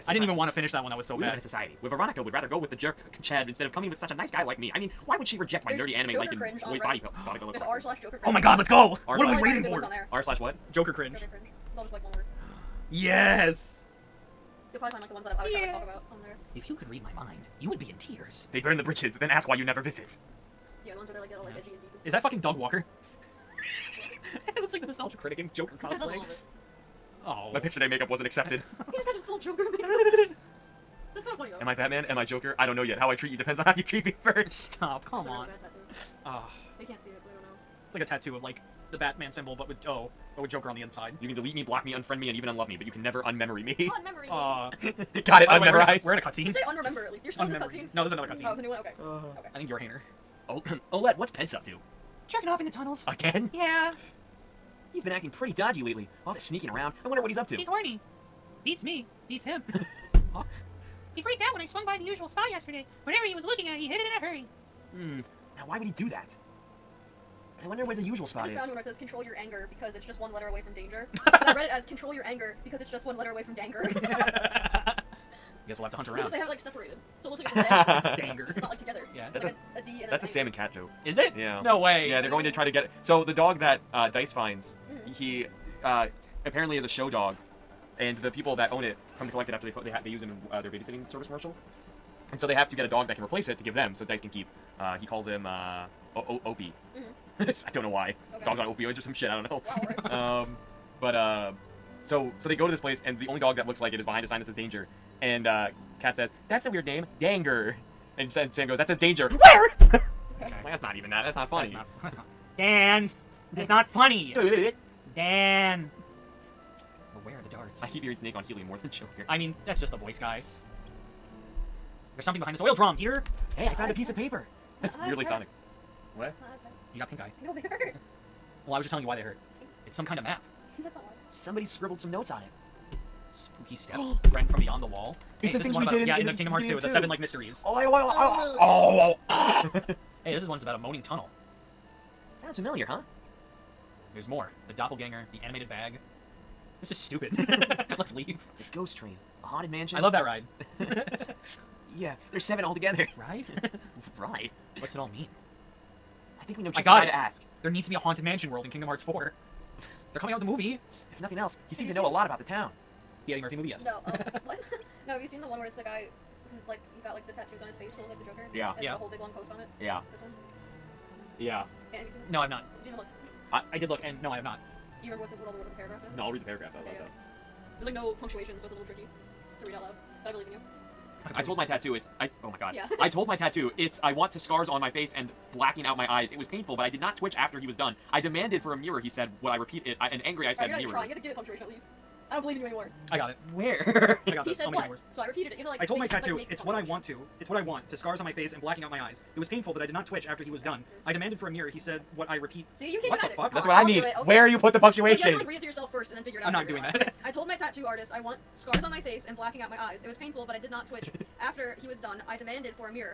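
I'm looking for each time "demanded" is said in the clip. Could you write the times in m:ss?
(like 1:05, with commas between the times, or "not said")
3:08, 3:21, 3:32.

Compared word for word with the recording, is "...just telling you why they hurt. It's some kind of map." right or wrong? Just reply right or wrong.
right.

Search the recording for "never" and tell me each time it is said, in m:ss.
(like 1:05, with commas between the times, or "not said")
0:19, 0:43.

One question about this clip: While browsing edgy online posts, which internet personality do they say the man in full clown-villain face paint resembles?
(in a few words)
Doug Walker.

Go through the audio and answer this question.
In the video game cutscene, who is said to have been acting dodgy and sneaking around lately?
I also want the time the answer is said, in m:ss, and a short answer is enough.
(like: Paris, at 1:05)
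Pence, at 0:51.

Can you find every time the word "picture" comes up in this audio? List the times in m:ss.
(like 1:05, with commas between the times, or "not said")
0:27.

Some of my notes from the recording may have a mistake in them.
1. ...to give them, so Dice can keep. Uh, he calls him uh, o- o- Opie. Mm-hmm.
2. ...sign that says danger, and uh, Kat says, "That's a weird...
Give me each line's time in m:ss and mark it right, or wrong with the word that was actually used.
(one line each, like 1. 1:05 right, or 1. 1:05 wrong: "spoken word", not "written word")
1. 1:33 right
2. 1:44 right.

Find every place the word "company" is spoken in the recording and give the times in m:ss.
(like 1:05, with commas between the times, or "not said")
not said.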